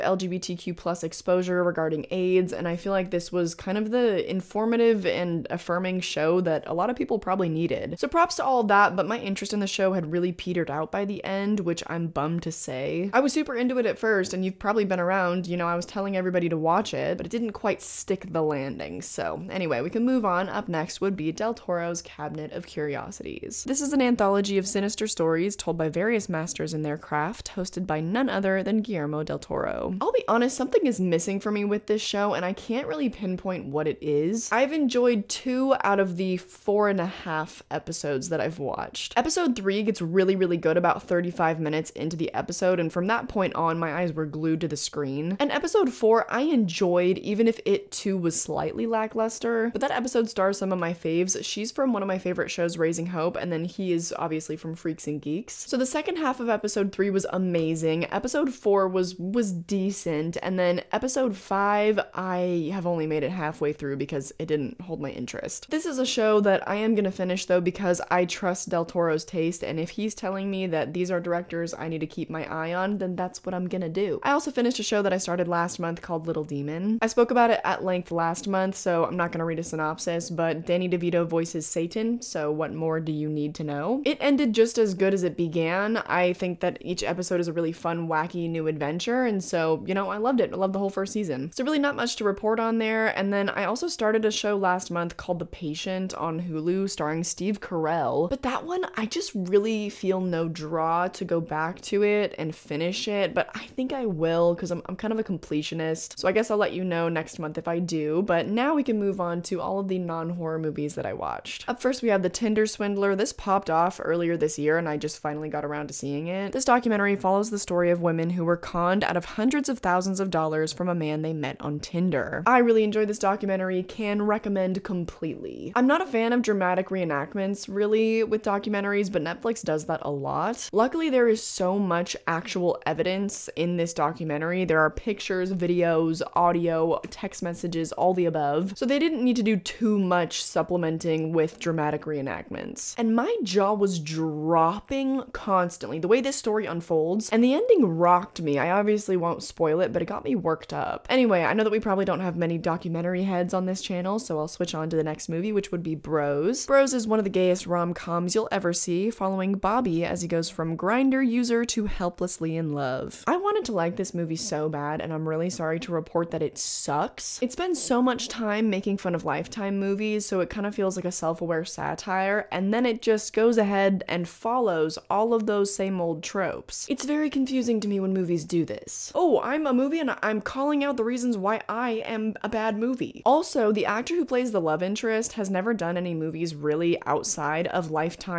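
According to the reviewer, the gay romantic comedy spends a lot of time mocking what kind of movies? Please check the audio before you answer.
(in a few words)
Lifetime movies.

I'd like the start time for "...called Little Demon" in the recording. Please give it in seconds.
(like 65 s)
76 s.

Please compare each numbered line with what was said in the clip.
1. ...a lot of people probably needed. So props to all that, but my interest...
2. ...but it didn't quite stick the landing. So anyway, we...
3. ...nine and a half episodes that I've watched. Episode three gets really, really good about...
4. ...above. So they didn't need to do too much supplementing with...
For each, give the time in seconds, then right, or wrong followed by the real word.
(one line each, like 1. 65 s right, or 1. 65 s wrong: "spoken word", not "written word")
1. 6 s right
2. 17 s right
3. 36 s wrong: "four", not "nine"
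4. 138 s right.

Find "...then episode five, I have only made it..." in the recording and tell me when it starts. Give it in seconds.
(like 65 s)
60 s.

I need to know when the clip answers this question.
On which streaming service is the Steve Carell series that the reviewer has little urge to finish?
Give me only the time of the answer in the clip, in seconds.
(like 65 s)
96 s.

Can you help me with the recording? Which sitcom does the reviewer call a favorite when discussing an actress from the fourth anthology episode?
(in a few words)
Raising Hope.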